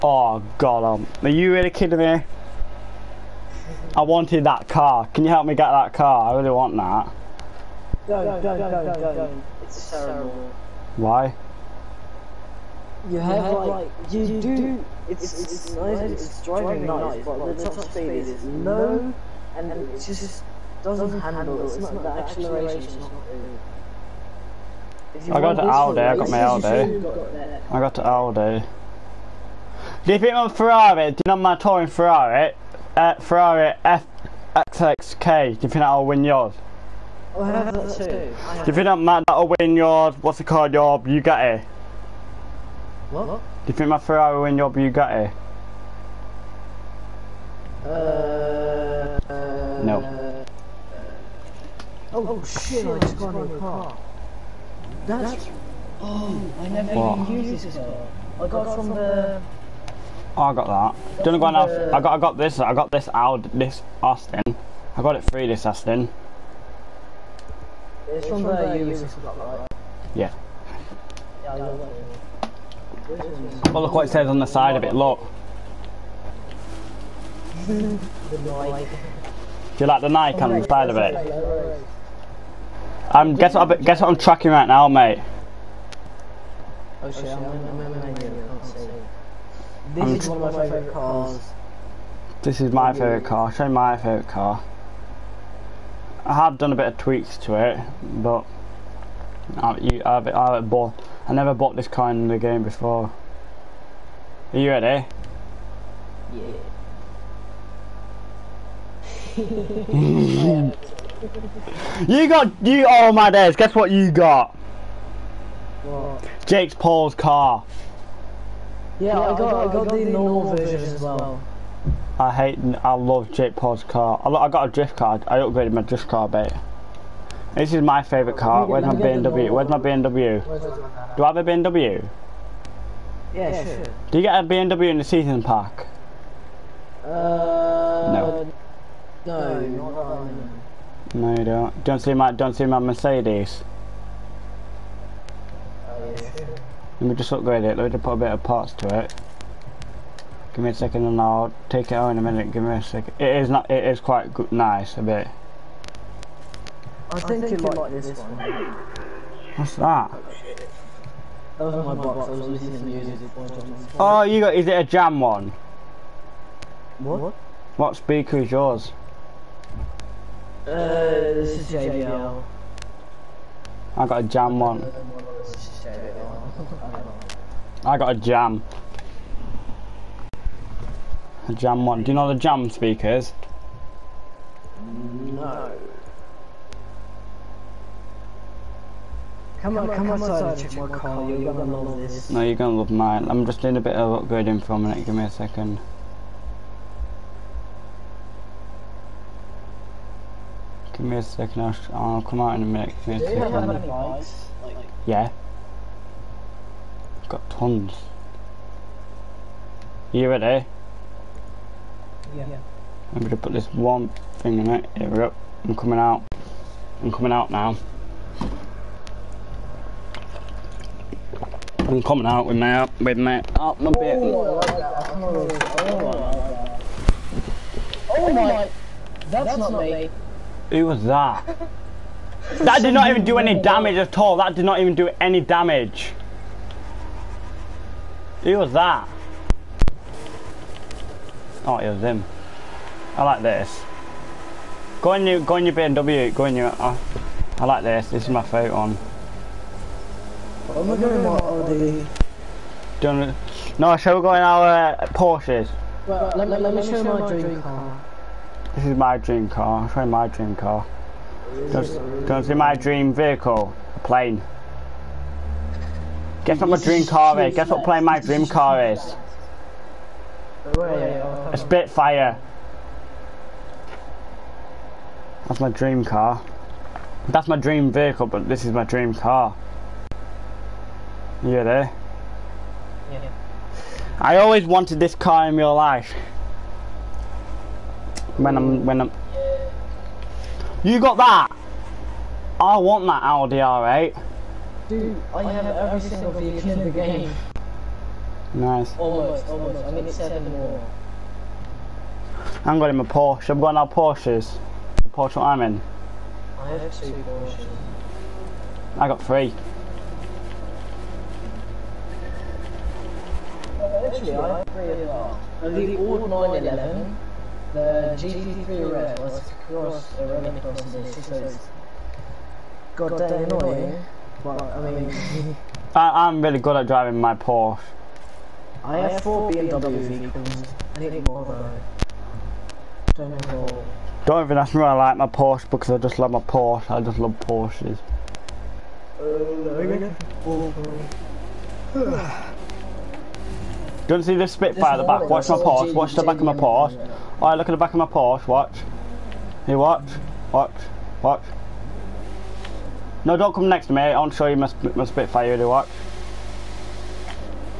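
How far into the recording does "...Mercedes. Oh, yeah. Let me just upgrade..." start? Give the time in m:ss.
2:22.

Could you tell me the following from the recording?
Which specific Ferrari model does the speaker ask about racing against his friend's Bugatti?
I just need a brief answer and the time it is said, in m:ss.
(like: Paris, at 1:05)
Ferrari FXXK, at 0:33.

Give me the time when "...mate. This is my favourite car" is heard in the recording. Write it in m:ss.
2:06.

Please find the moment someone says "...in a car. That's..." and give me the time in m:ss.
0:53.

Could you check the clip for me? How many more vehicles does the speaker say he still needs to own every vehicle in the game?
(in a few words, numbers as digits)
7.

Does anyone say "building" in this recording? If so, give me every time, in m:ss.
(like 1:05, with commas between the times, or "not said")
not said.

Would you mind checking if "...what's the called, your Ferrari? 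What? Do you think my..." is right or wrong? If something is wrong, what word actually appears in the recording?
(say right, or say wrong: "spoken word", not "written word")
wrong: "Bugatti", not "Ferrari".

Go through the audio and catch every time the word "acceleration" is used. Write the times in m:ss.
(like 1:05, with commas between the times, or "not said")
0:22.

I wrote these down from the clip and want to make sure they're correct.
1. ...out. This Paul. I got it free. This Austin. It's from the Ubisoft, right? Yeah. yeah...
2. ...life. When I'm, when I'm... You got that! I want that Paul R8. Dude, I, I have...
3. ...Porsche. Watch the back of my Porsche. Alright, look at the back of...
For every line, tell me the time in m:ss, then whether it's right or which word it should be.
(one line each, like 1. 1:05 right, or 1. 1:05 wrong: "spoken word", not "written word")
1. 1:03 wrong: "Austin", not "Paul"
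2. 4:45 wrong: "Audi", not "Paul"
3. 5:45 right.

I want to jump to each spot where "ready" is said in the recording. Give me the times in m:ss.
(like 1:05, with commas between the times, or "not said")
1:44, 3:30.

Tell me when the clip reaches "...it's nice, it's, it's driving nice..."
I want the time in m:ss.
0:15.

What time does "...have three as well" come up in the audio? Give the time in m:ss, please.
5:14.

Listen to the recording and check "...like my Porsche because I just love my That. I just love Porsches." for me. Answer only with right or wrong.
wrong.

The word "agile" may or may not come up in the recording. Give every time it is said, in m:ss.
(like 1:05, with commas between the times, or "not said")
not said.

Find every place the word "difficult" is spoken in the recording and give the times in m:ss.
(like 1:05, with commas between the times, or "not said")
not said.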